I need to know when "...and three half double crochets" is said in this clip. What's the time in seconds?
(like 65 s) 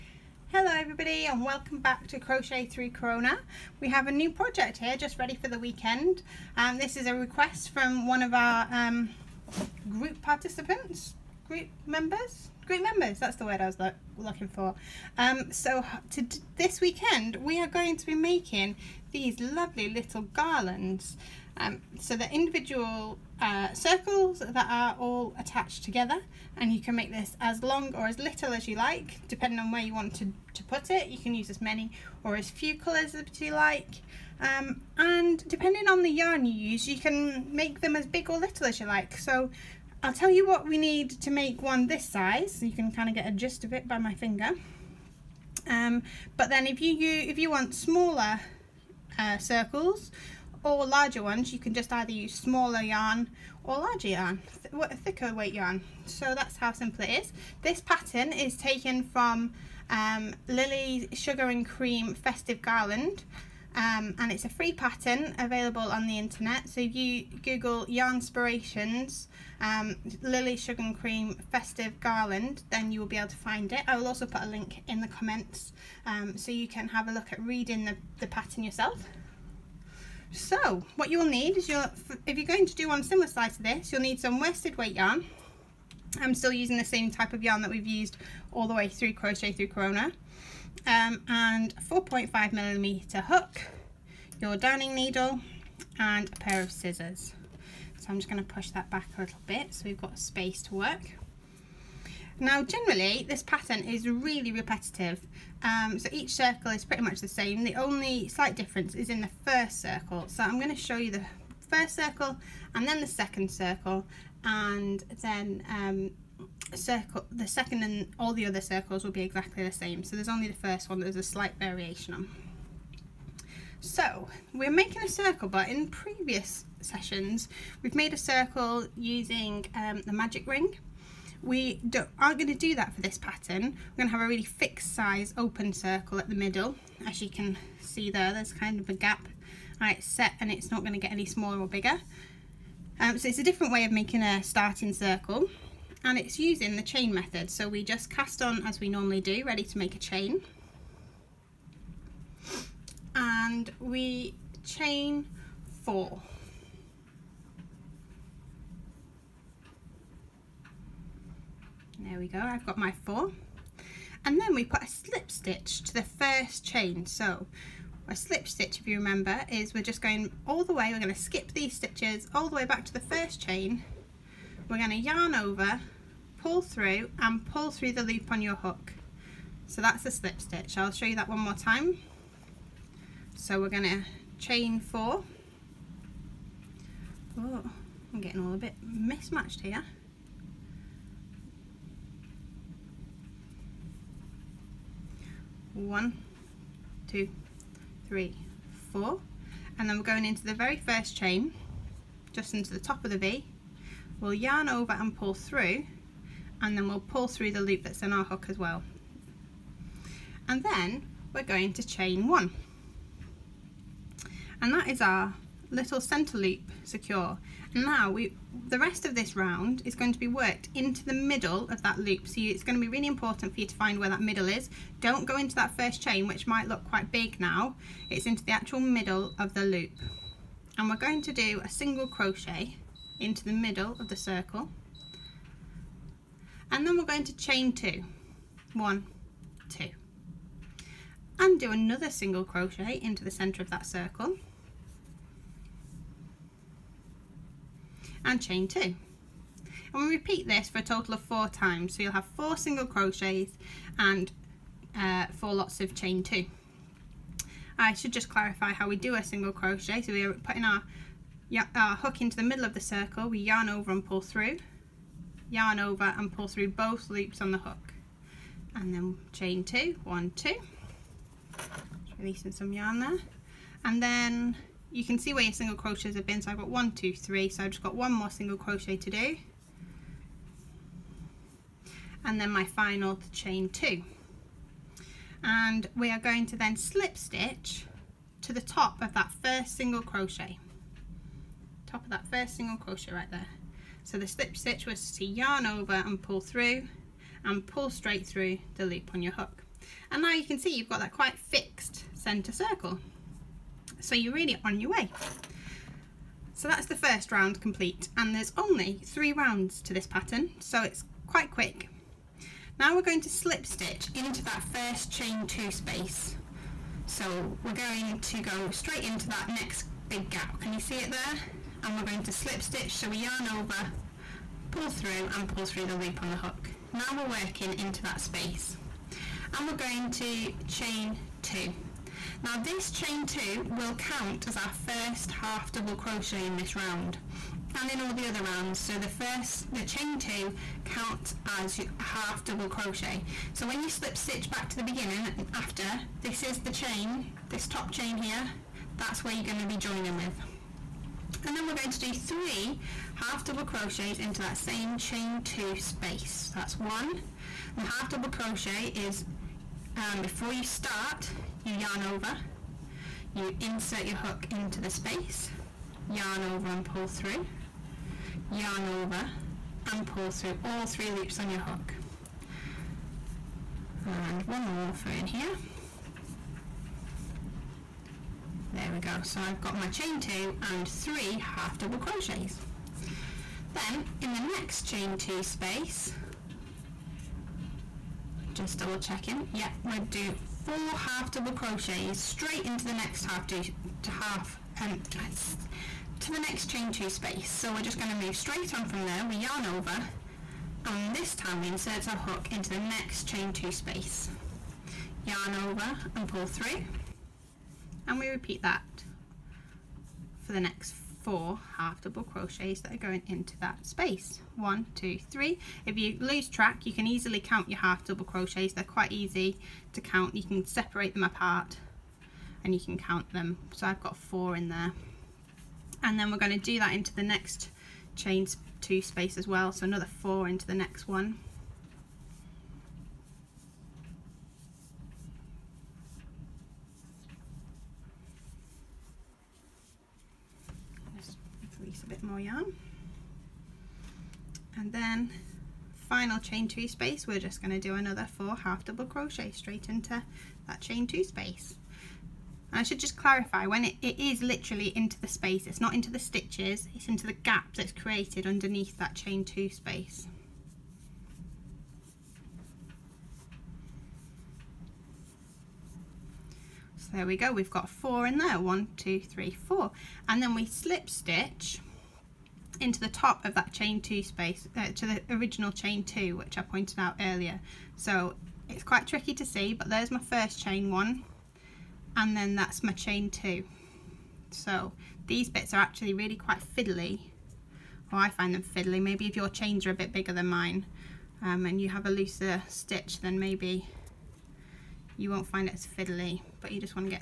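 380 s.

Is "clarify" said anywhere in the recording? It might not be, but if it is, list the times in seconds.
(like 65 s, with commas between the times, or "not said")
258 s, 453 s.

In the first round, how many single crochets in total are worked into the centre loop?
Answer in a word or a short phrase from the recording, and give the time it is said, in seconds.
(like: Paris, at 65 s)
4, at 252 s.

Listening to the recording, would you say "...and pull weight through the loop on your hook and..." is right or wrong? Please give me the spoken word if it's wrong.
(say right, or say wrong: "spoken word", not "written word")
wrong: "straight", not "weight".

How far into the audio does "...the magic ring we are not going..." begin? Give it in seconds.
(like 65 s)
130 s.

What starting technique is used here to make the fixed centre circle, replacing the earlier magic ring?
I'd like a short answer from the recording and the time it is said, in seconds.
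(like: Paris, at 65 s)
Chain method, at 146 s.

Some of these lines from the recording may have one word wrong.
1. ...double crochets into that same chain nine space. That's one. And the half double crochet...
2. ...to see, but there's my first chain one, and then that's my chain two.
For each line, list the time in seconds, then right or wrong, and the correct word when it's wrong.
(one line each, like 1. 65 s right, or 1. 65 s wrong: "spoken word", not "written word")
1. 353 s wrong: "two", not "nine"
2. 479 s right.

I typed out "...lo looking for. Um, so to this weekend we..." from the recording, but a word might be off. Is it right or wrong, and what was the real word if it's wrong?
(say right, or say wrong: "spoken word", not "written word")
right.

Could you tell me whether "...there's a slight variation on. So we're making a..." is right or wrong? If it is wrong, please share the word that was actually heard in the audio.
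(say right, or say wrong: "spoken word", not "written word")
right.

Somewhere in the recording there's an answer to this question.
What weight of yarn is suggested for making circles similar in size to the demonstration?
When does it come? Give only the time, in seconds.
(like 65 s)
84 s.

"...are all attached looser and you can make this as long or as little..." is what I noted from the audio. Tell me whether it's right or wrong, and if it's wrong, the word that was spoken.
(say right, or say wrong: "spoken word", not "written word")
wrong: "together", not "looser".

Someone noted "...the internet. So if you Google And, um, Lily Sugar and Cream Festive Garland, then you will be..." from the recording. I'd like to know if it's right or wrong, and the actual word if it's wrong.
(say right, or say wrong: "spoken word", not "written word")
wrong: "Yarnspirations", not "And".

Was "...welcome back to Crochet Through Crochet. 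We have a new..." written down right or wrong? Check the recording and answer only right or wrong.
wrong.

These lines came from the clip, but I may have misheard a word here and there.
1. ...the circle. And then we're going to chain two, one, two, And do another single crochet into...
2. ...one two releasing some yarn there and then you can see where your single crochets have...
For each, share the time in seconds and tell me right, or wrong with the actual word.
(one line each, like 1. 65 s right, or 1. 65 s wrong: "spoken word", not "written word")
1. 234 s right
2. 270 s right.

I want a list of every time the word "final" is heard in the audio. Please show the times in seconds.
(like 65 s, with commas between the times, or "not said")
282 s, 446 s.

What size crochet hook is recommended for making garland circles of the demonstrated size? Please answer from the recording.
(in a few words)
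4.5 millimeter.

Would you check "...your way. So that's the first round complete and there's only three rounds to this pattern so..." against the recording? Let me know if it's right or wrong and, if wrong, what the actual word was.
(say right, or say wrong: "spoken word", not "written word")
right.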